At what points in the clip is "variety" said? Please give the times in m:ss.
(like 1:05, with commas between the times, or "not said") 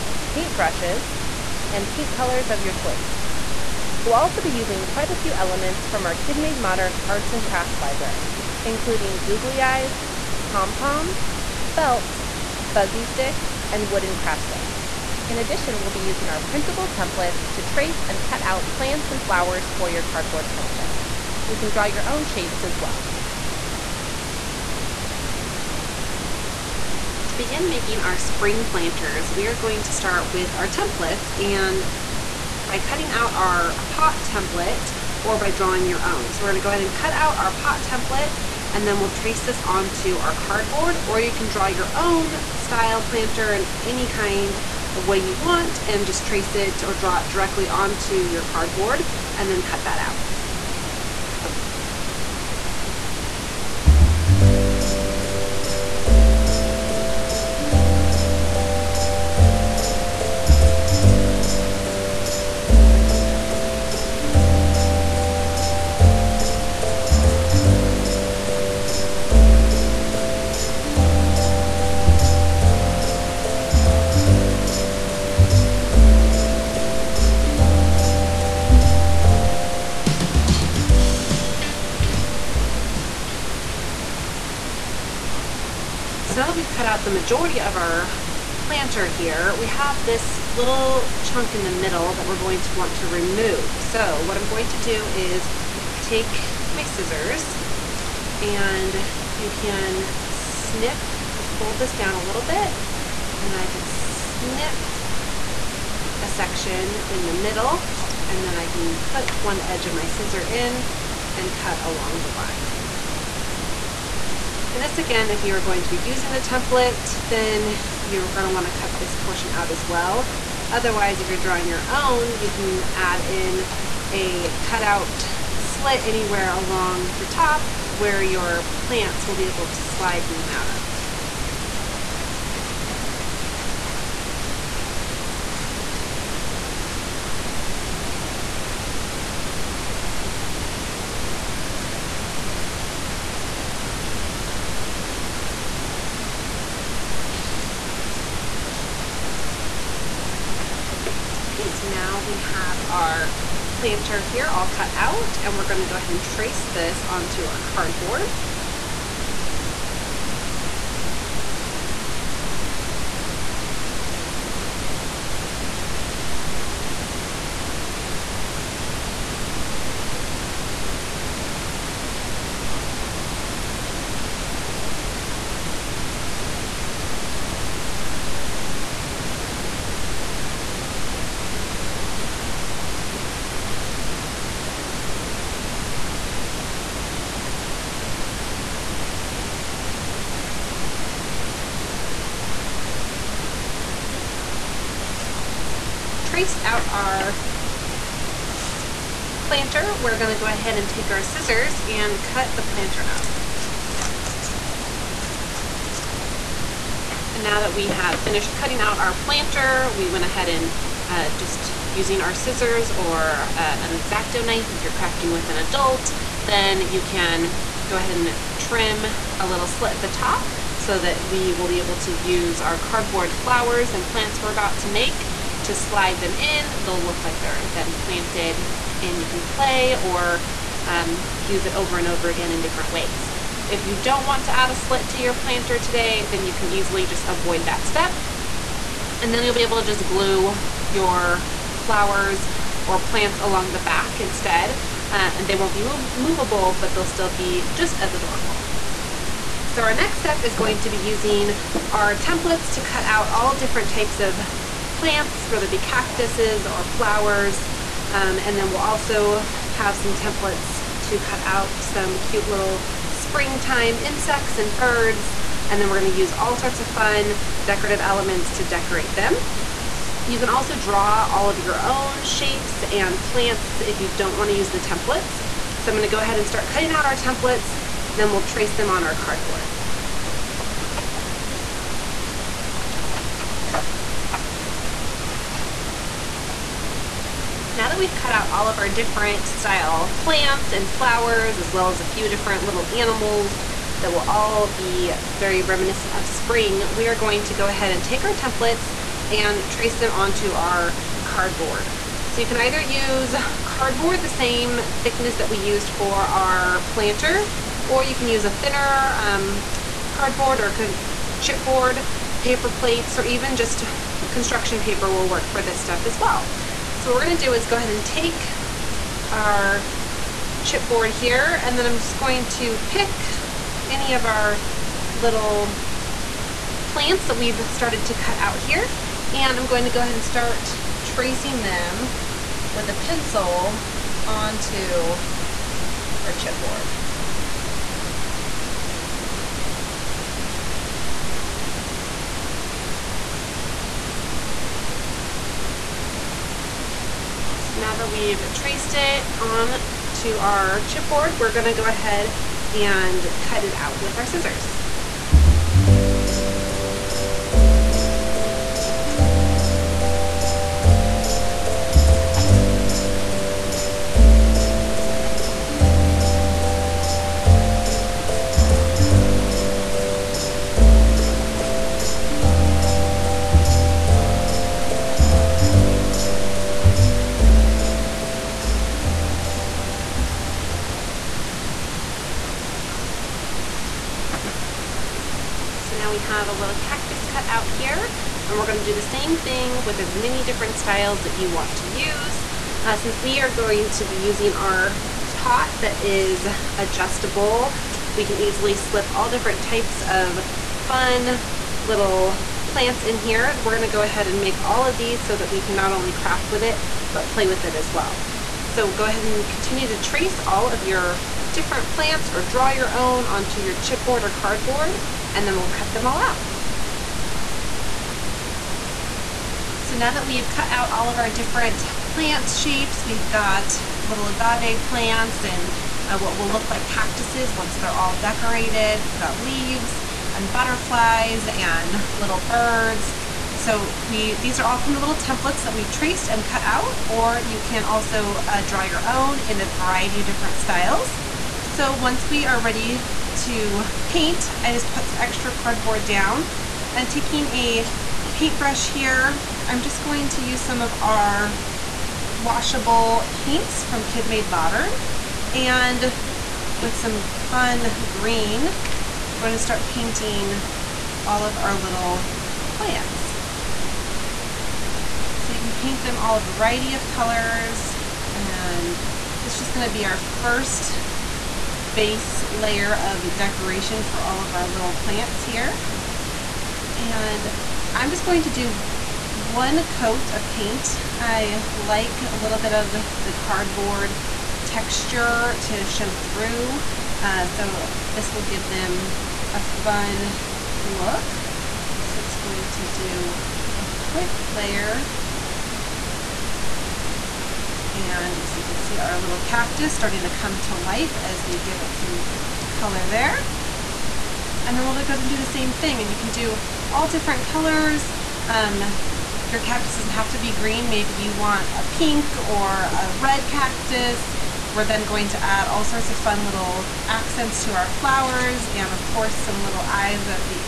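7:19, 7:46.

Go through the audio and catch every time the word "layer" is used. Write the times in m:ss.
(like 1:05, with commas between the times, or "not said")
7:52, 8:14.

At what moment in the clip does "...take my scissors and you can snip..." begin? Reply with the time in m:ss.
1:36.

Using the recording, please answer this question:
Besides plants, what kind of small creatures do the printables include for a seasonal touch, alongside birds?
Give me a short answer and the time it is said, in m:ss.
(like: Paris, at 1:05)
Insects, at 4:23.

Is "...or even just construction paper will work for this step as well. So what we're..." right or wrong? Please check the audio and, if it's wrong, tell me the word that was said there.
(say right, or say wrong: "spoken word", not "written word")
right.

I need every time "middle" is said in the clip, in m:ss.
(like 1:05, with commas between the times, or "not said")
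1:31, 1:47.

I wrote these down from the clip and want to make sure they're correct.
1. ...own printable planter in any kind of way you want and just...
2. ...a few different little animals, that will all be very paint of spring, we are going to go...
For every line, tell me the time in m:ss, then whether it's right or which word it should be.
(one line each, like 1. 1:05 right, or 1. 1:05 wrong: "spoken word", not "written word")
1. 0:41 wrong: "style", not "printable"
2. 4:52 wrong: "reminiscent", not "paint".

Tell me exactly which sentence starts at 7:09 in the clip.
We've got leaves and butterflies and little birds.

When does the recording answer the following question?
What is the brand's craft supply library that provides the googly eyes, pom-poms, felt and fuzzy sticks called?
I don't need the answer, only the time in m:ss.
0:06.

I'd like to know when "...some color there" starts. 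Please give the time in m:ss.
8:21.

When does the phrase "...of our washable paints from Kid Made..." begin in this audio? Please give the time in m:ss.
7:30.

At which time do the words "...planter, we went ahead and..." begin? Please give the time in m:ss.
3:29.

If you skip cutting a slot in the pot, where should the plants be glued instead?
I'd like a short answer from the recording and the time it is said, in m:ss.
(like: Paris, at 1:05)
Along the back, at 4:03.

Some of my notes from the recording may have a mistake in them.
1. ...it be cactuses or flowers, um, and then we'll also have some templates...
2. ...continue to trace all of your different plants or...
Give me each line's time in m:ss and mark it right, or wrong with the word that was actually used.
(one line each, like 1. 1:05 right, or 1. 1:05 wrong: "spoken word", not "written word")
1. 4:15 right
2. 6:49 right.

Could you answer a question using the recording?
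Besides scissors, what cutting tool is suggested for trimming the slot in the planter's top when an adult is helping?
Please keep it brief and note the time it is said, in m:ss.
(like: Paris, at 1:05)
X-Acto knife, at 3:34.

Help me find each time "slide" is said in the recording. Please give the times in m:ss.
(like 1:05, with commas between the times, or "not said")
2:09, 3:45.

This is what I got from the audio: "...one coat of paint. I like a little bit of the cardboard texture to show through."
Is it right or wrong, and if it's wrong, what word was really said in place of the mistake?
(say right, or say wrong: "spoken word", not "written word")
right.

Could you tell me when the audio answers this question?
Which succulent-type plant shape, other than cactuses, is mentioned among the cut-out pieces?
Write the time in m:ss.
7:04.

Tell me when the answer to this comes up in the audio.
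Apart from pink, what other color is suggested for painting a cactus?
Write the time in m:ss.
8:33.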